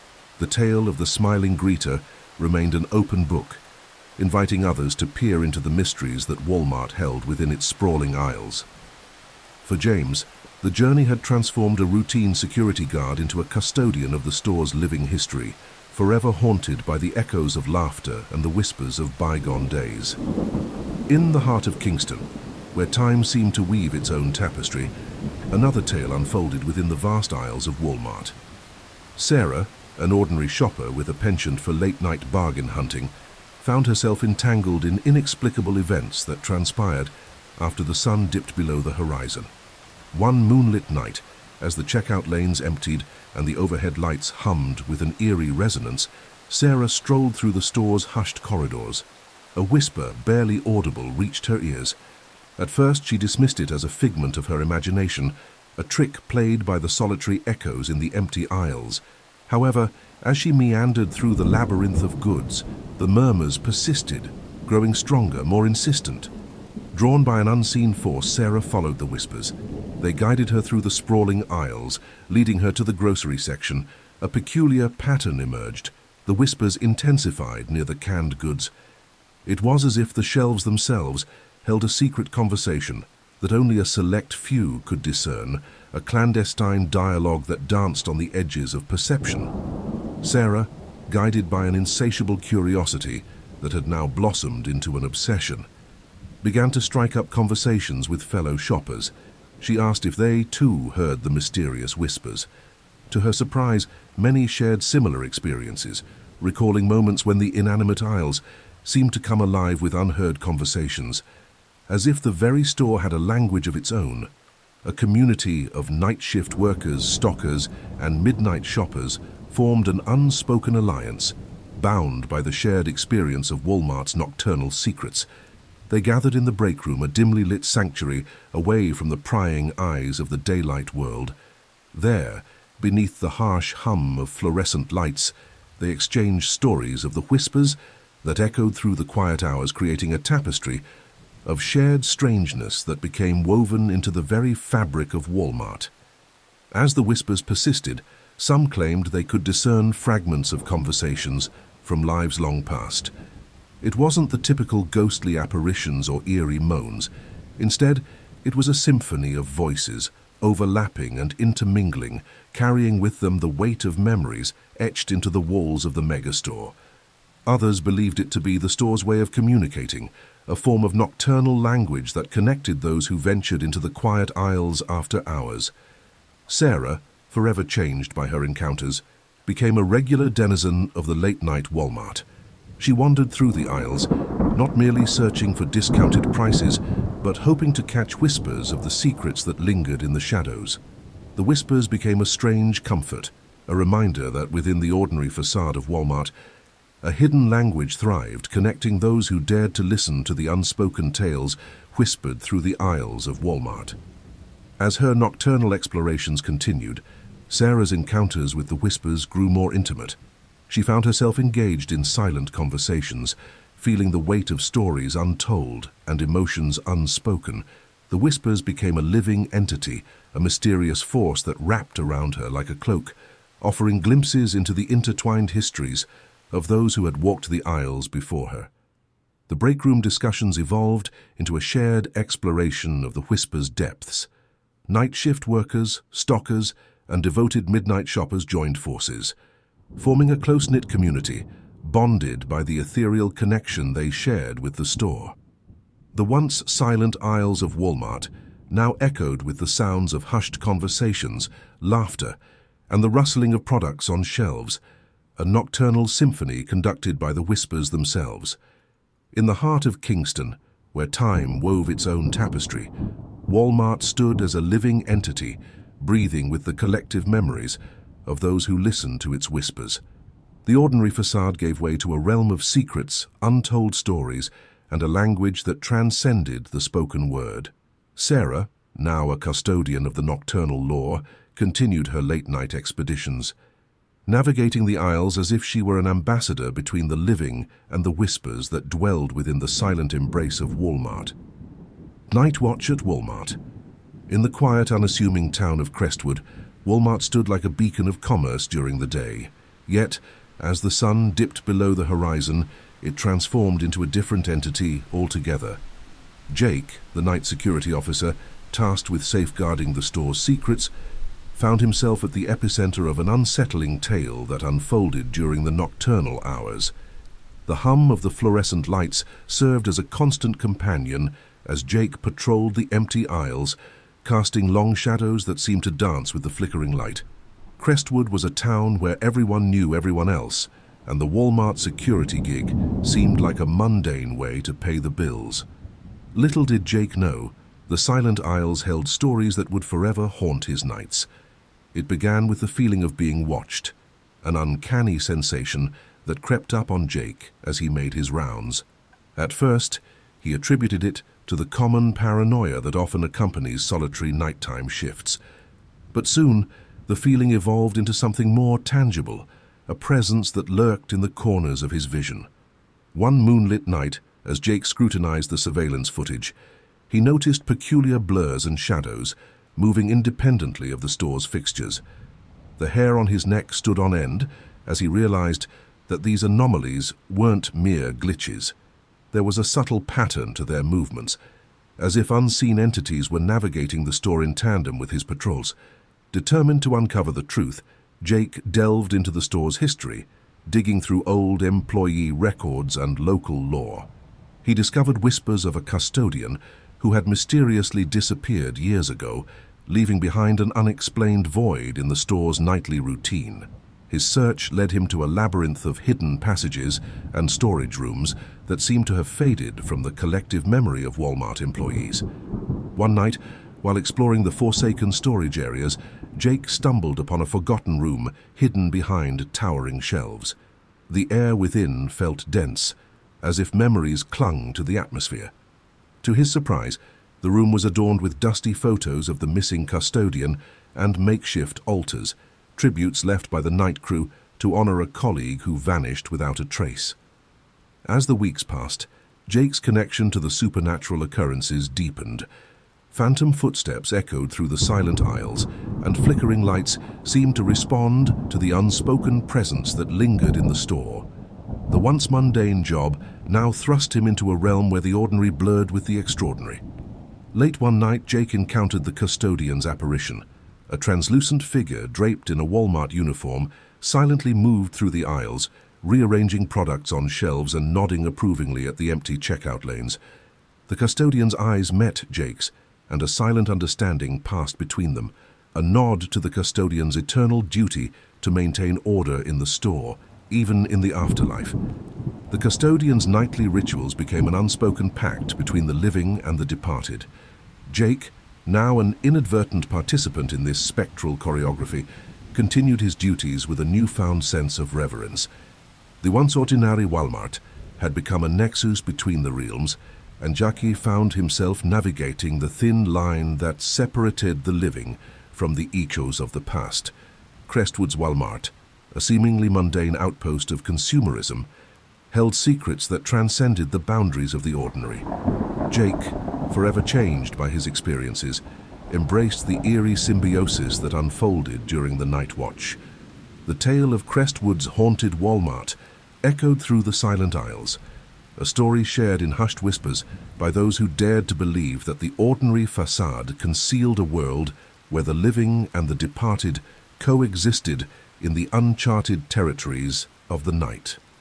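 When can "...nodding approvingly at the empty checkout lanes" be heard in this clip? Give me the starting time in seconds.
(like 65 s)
467 s.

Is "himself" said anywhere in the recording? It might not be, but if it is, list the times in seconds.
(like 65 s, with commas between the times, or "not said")
311 s, 501 s.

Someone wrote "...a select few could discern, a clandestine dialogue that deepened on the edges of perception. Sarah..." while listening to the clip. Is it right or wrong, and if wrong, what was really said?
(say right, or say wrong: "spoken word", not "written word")
wrong: "danced", not "deepened".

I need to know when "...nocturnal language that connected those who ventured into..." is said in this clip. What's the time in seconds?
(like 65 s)
170 s.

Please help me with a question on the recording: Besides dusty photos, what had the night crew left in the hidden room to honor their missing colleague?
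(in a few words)
Makeshift altars.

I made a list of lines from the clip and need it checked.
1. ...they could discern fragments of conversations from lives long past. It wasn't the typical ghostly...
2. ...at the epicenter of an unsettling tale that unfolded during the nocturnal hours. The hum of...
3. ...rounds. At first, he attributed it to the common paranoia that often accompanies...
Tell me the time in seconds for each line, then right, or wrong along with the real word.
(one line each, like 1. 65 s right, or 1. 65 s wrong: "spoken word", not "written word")
1. 149 s right
2. 312 s right
3. 348 s right.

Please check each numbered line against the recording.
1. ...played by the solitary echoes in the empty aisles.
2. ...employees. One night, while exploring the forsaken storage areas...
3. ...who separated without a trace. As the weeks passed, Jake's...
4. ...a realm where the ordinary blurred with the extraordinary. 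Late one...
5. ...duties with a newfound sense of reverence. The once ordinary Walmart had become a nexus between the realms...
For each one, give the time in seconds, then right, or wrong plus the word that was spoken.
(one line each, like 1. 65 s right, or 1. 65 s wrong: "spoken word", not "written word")
1. 56 s right
2. 411 s right
3. 435 s wrong: "vanished", not "separated"
4. 454 s right
5. 493 s right.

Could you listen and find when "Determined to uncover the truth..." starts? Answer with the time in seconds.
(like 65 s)
386 s.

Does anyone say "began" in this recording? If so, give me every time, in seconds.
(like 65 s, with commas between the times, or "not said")
96 s, 342 s.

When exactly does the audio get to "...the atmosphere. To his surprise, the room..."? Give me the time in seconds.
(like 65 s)
424 s.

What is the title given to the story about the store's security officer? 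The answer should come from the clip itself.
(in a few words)
Night Watch at Walmart.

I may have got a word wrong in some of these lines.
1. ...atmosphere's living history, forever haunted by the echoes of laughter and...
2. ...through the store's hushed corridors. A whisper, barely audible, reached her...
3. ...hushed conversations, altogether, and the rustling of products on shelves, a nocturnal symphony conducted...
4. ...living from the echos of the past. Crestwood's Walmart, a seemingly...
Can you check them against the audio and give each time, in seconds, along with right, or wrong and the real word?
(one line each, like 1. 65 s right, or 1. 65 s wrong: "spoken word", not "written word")
1. 14 s wrong: "store", not "atmosphere"
2. 47 s right
3. 250 s wrong: "laughter", not "altogether"
4. 504 s right.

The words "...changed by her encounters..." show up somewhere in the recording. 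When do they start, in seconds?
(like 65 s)
177 s.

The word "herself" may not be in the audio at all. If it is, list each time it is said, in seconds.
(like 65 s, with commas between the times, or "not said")
33 s, 211 s.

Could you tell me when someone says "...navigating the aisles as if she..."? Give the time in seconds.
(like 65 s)
284 s.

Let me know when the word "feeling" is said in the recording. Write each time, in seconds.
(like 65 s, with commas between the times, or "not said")
213 s, 342 s, 357 s.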